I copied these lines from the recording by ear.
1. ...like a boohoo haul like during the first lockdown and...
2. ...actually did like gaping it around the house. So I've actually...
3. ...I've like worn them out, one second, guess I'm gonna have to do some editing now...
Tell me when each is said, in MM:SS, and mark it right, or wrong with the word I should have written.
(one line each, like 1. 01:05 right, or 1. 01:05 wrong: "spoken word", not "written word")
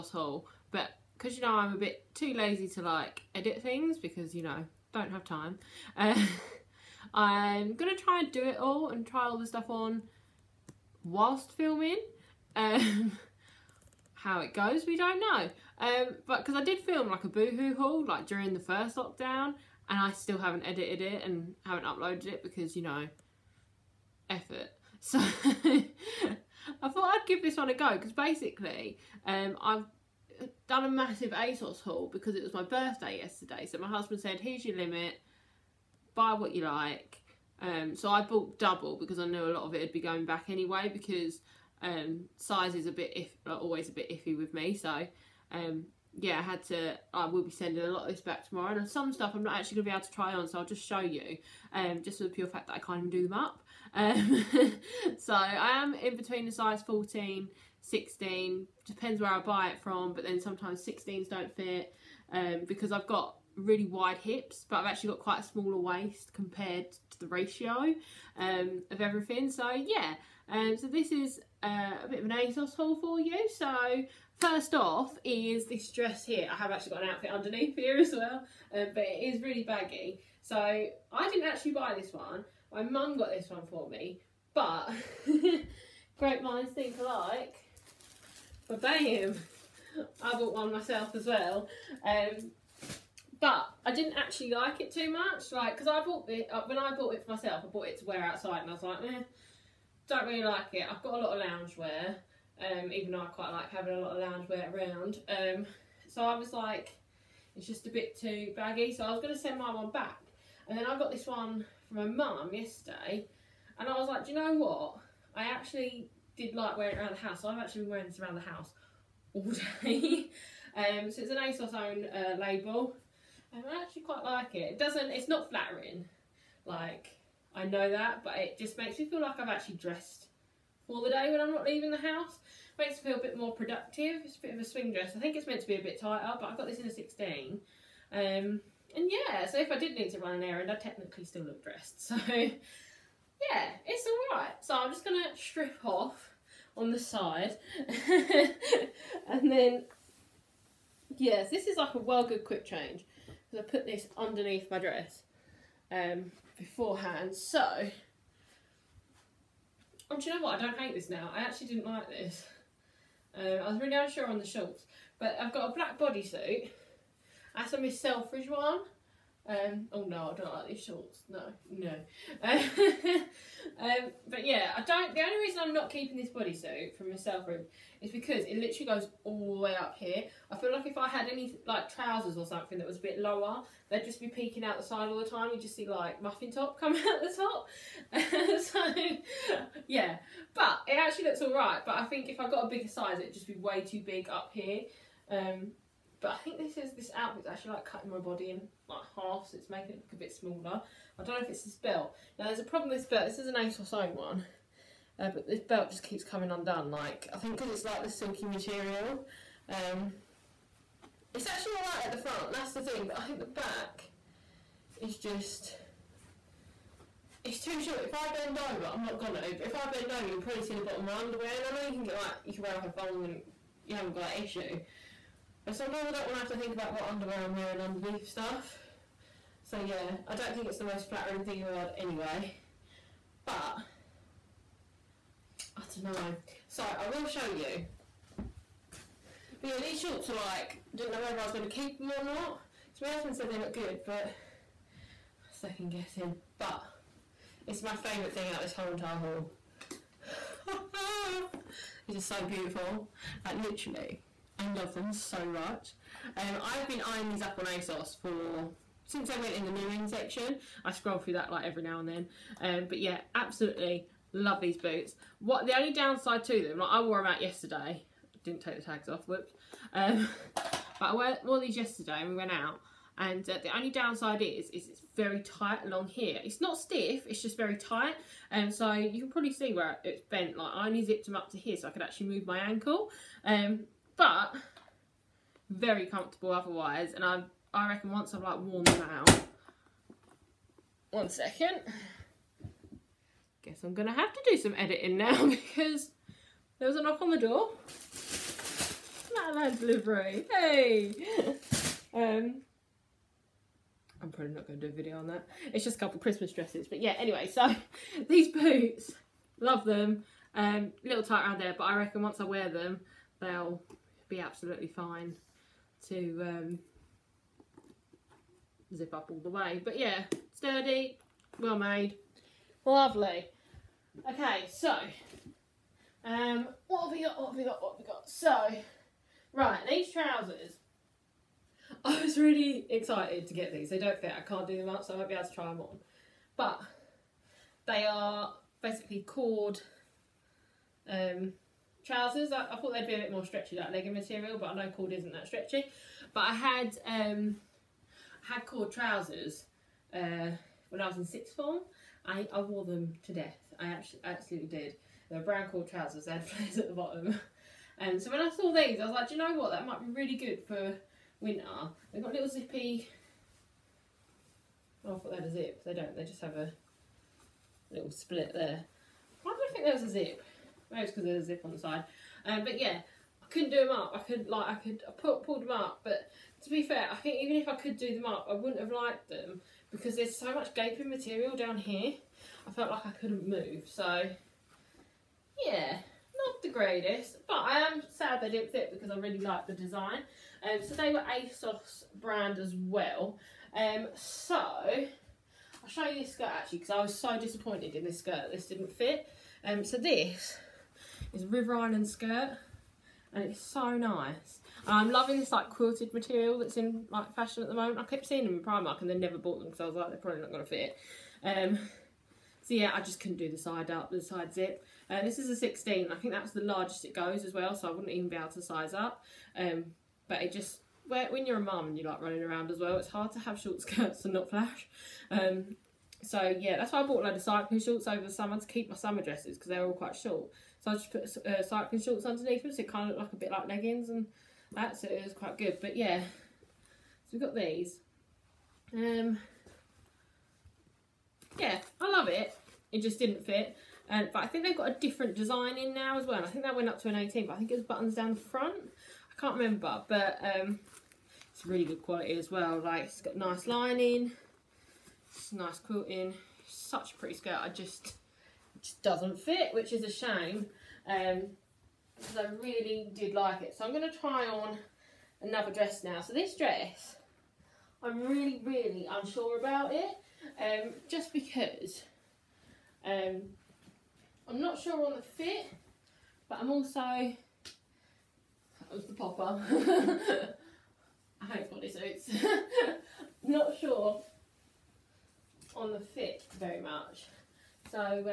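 1. 00:17 right
2. 01:55 wrong: "wearing", not "gaping"
3. 04:48 right.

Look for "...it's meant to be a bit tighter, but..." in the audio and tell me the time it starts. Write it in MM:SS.
02:15.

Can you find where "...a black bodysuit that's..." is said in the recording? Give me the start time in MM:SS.
02:45.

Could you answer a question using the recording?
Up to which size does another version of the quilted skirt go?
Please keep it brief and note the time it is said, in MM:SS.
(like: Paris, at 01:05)
18, at 07:27.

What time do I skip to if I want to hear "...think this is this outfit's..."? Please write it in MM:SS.
03:16.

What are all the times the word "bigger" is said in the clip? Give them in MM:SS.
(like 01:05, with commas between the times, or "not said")
03:12.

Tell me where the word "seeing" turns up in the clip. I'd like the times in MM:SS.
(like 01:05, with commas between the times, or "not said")
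06:48.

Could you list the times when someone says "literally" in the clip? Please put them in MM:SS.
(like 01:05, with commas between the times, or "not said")
02:58, 04:13.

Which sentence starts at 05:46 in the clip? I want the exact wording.
But I had um, had cord trousers uh, when I was in sixth form.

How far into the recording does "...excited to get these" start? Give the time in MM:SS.
05:32.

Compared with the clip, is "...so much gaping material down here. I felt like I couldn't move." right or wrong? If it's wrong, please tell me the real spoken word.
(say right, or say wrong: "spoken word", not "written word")
right.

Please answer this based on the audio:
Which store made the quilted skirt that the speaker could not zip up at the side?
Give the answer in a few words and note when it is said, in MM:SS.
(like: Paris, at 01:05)
River Island, at 06:41.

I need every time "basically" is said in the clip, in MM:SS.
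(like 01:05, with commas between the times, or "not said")
00:28, 05:38.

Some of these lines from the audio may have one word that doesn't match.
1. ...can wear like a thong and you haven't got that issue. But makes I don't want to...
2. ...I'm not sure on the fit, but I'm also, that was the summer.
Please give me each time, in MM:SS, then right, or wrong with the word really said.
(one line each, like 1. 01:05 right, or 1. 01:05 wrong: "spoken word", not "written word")
1. 03:42 wrong: "sometimes", not "makes"
2. 07:54 wrong: "popper", not "summer".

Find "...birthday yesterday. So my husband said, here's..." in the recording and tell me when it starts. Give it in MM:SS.
00:32.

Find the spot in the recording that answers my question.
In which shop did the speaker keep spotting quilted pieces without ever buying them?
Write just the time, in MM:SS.
06:48.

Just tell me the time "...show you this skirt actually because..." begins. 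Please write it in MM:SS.
06:35.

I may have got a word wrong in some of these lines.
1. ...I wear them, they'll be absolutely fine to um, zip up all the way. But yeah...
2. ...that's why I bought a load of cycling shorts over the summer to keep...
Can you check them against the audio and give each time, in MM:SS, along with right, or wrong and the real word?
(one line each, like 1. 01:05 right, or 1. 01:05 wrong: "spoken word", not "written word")
1. 05:12 right
2. 07:06 right.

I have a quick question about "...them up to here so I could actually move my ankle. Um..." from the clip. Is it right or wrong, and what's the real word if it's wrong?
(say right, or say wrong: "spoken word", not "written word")
right.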